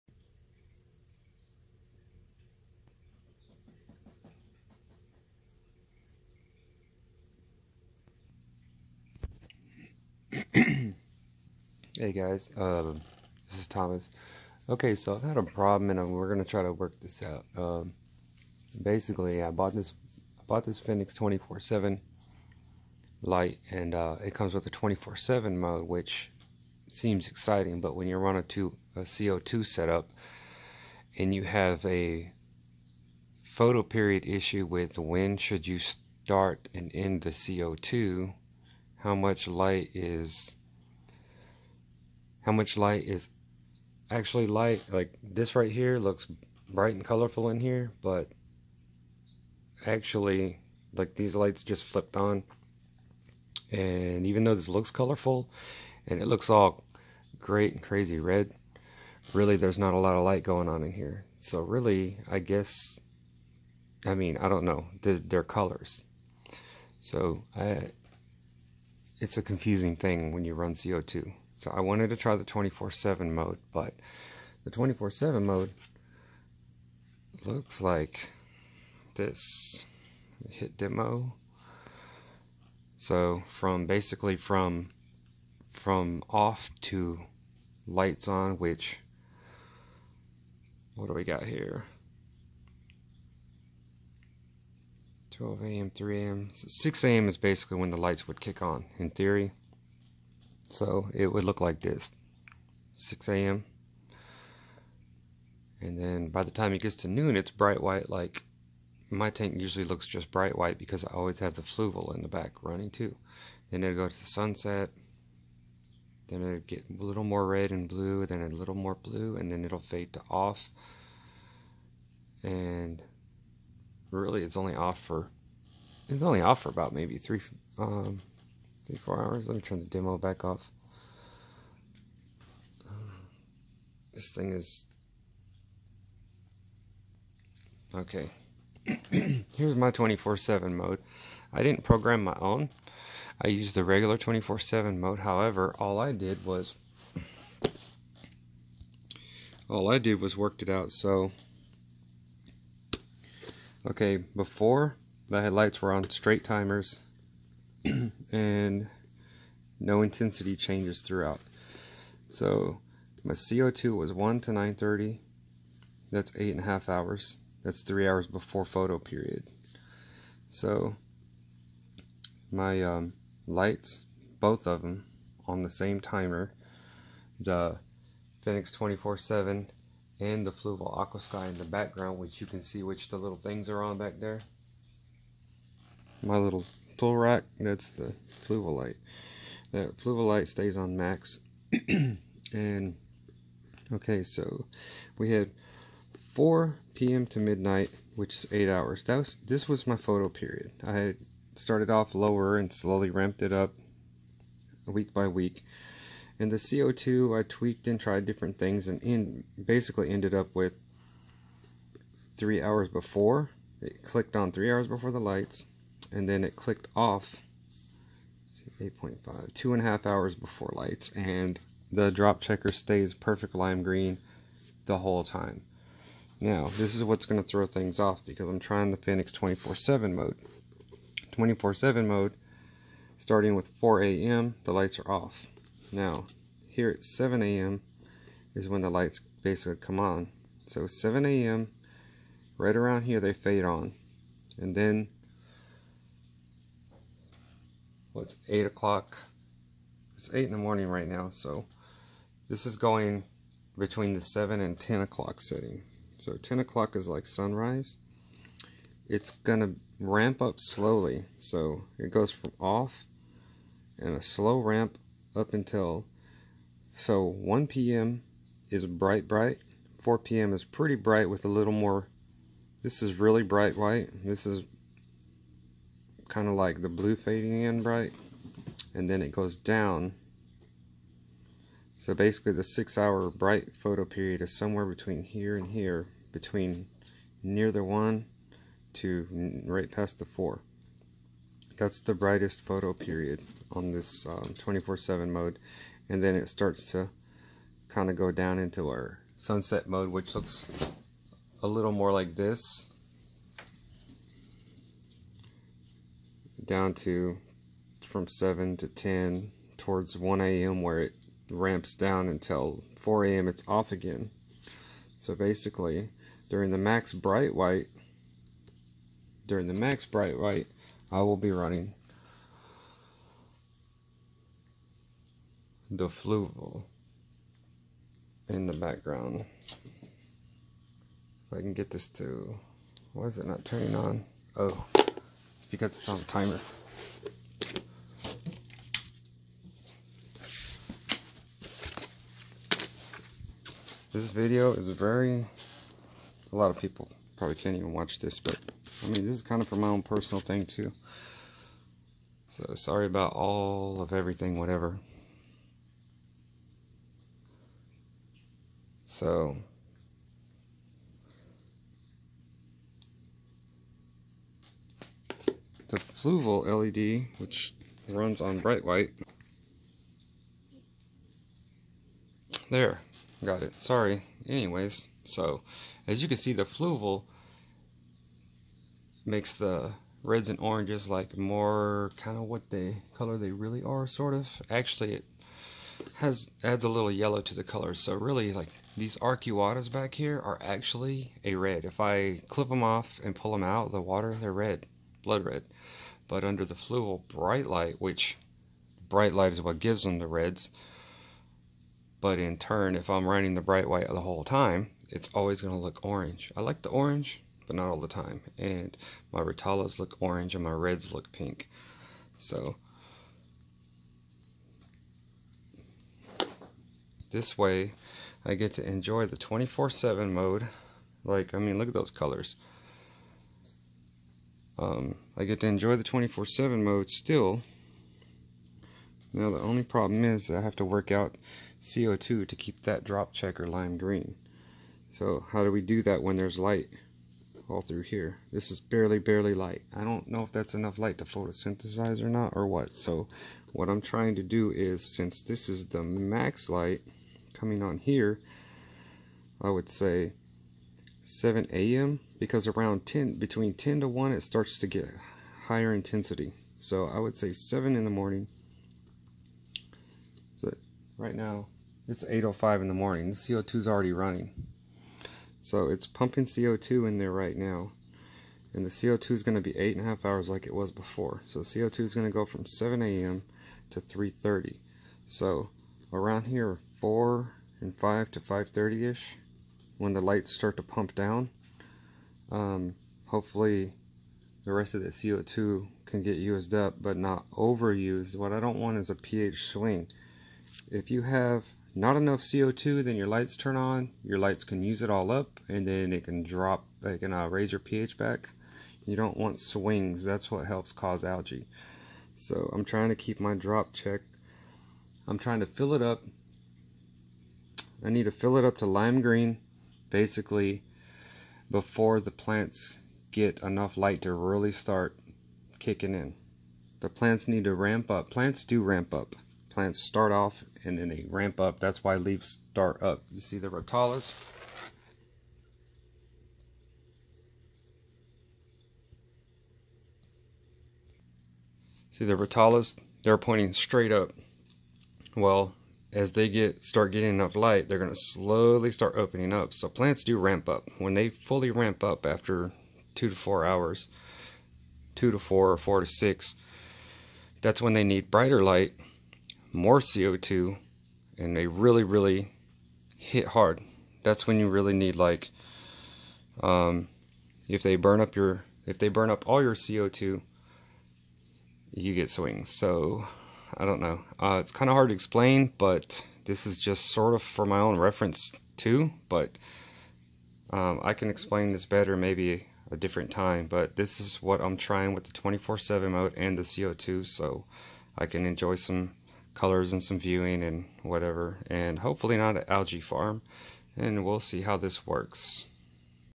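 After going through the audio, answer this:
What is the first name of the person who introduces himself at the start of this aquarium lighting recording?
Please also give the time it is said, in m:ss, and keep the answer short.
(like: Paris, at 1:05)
Thomas, at 0:13.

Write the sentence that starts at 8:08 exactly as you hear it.
What I don't want is a pH swing.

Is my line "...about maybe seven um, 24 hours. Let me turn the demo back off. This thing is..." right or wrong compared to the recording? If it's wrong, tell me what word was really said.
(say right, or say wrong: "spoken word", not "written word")
wrong: "three", not "seven".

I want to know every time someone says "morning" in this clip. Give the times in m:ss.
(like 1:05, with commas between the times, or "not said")
4:10, 7:38, 7:42.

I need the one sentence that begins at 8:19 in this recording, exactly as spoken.
You don't want swings, that's what helps cause algae.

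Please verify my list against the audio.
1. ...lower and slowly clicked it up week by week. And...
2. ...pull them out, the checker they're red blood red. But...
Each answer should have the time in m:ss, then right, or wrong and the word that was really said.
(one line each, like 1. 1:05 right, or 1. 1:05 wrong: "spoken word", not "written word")
1. 3:22 wrong: "ramped", not "clicked"
2. 6:33 wrong: "water", not "checker".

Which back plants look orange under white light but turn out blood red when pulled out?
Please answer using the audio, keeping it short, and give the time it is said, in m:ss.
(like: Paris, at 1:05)
Arcuatas, at 6:29.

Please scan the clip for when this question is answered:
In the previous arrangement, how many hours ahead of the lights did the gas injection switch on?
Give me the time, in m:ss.
2:47.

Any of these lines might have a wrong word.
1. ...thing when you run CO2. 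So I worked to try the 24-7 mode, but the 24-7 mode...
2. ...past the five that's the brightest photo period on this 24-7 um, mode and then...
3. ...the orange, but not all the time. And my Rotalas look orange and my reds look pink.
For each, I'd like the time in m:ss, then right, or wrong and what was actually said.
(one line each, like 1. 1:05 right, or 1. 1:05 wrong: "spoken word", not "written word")
1. 1:09 wrong: "wanted", not "worked"
2. 4:49 wrong: "four", not "five"
3. 6:46 right.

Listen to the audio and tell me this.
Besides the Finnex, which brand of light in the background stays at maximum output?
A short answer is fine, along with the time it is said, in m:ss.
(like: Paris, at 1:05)
Fluval Aquasky, at 3:00.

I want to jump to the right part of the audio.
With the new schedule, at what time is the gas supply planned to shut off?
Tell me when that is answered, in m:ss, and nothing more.
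7:54.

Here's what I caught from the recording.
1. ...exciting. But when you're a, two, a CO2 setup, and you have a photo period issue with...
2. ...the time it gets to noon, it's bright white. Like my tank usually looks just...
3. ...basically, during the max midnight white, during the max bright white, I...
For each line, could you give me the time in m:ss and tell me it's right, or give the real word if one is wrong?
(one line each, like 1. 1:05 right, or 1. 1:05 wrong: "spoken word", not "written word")
1. 0:27 right
2. 1:46 right
3. 5:15 wrong: "bright", not "midnight".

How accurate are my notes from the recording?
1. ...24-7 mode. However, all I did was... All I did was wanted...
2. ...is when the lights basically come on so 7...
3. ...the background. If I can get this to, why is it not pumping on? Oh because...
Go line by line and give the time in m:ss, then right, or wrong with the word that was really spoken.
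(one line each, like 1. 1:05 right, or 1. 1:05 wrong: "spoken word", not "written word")
1. 2:24 wrong: "worked", not "wanted"
2. 3:58 right
3. 5:28 wrong: "turning", not "pumping".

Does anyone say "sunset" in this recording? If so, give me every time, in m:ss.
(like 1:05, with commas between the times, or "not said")
1:54, 4:59.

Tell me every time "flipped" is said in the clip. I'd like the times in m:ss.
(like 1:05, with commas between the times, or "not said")
0:51.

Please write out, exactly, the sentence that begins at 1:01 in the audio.
So, really, I guess, I mean, I don't know, they're, they're colors.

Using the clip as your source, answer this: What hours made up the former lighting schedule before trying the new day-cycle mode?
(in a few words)
4 p.m. to midnight.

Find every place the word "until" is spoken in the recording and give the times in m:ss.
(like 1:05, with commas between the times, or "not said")
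4:25, 5:12.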